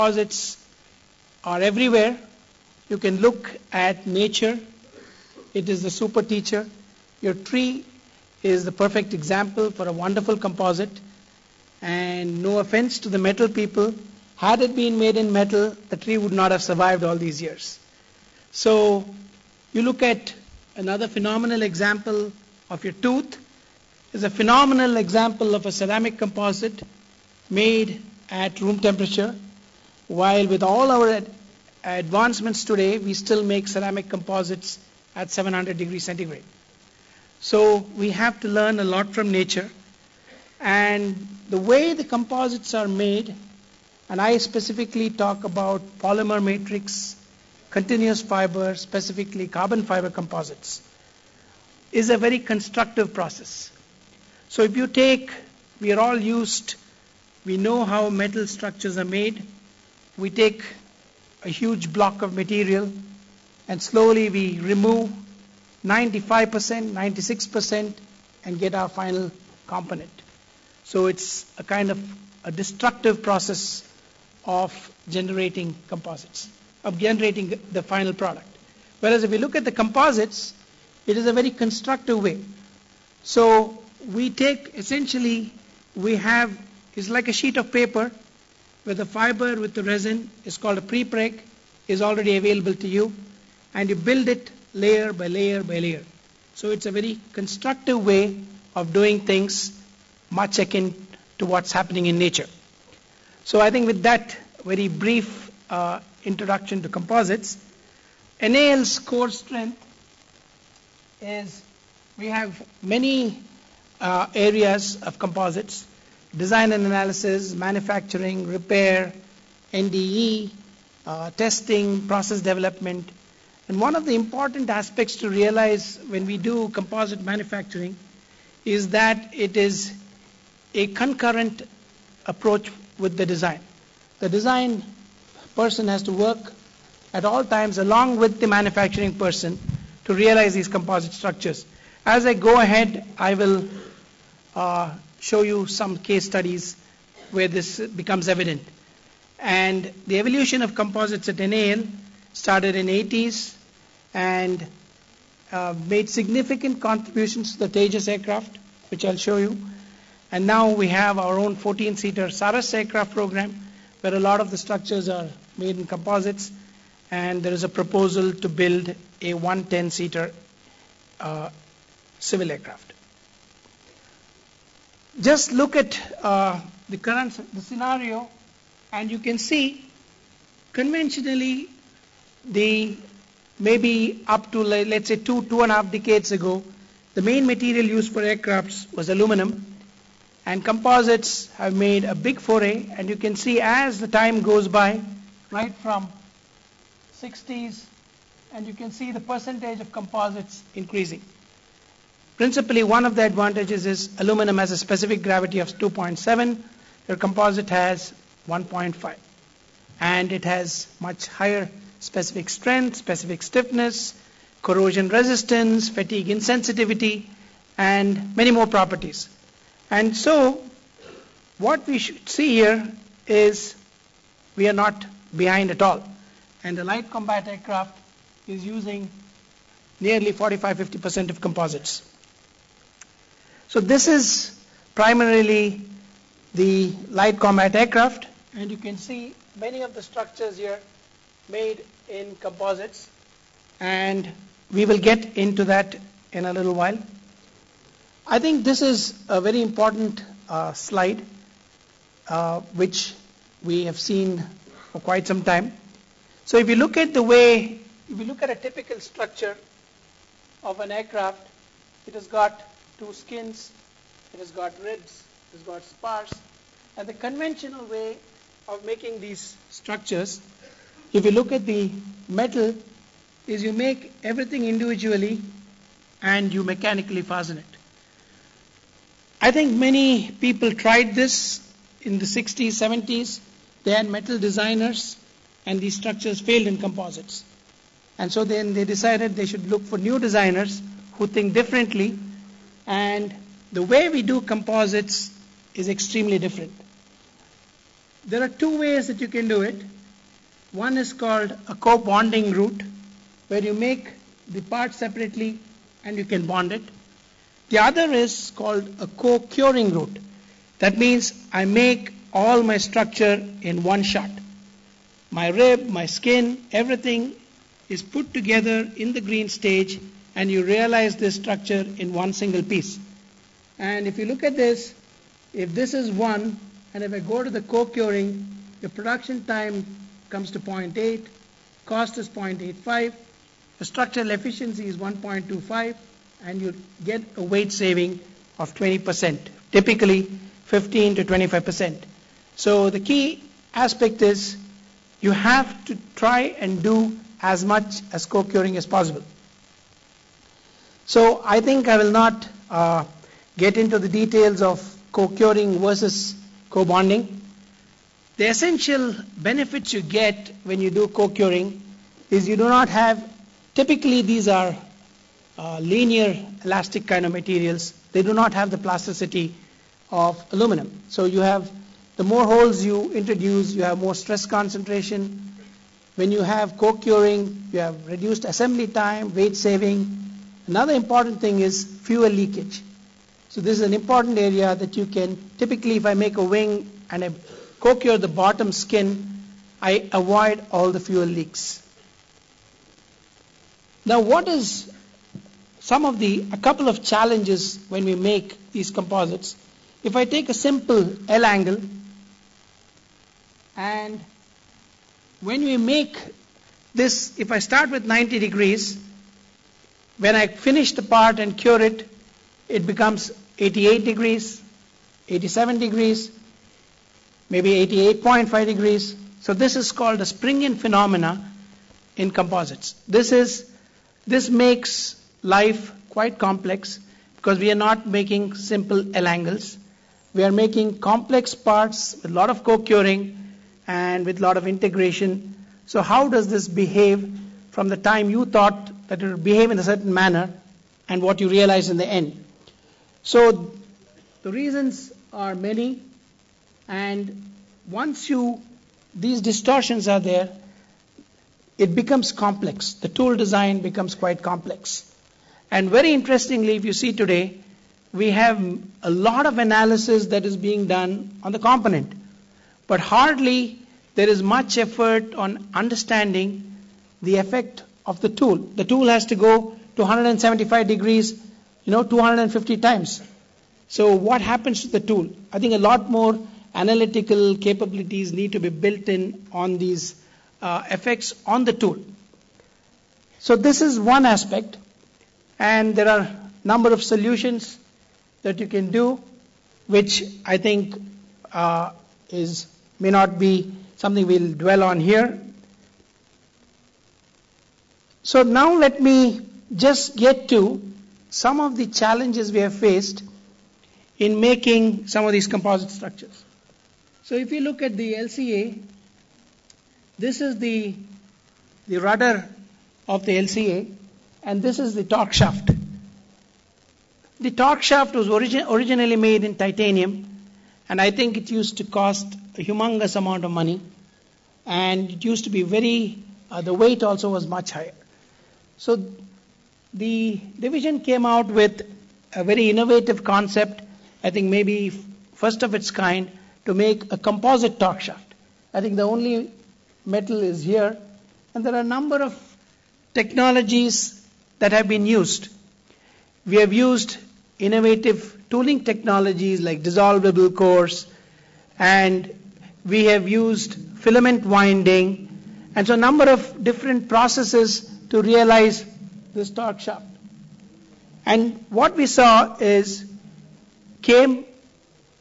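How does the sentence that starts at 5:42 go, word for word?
So the key aspect is you have to try and do as much as co-curing as possible.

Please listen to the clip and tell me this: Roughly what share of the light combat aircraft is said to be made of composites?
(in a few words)
45-50%.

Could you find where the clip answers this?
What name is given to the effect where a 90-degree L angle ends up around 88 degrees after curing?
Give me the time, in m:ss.
7:00.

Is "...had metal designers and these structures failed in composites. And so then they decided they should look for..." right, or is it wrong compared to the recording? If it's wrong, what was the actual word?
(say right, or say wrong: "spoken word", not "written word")
right.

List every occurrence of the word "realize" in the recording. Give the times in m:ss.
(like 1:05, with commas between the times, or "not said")
2:05, 2:20, 5:20, 7:21, 9:18.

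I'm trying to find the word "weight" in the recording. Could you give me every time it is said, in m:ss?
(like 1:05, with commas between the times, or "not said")
5:37, 6:19, 8:46.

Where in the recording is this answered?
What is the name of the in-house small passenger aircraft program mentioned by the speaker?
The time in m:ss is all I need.
2:42.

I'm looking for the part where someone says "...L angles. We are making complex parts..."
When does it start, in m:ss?
7:09.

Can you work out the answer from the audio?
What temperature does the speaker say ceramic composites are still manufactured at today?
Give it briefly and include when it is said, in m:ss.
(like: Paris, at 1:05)
700 degrees centigrade, at 0:35.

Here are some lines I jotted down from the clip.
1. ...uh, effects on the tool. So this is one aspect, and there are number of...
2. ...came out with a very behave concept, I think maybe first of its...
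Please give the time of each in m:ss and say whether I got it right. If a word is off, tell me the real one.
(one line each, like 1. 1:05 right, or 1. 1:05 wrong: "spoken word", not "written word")
1. 8:00 right
2. 8:51 wrong: "innovative", not "behave".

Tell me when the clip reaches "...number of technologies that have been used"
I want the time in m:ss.
9:01.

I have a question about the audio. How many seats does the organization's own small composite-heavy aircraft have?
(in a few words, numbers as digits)
14.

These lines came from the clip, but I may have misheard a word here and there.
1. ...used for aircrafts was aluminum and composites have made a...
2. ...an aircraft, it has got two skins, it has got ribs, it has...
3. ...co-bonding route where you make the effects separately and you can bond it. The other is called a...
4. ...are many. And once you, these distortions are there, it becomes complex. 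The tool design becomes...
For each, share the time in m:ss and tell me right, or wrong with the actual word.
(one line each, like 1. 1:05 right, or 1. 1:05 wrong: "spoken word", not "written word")
1. 3:07 right
2. 4:20 right
3. 5:01 wrong: "parts", not "effects"
4. 7:25 right.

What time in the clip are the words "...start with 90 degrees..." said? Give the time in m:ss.
6:47.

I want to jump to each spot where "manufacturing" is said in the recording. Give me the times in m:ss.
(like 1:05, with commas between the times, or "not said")
1:57, 2:07, 2:18.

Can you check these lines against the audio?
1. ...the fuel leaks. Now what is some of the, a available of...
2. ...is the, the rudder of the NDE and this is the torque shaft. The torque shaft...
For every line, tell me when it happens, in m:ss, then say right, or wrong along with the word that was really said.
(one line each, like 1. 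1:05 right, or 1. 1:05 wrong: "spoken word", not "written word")
1. 6:30 wrong: "couple", not "available"
2. 8:30 wrong: "LCA", not "NDE".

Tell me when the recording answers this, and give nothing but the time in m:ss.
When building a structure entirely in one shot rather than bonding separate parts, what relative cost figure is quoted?
5:32.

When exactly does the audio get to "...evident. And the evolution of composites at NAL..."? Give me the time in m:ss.
2:28.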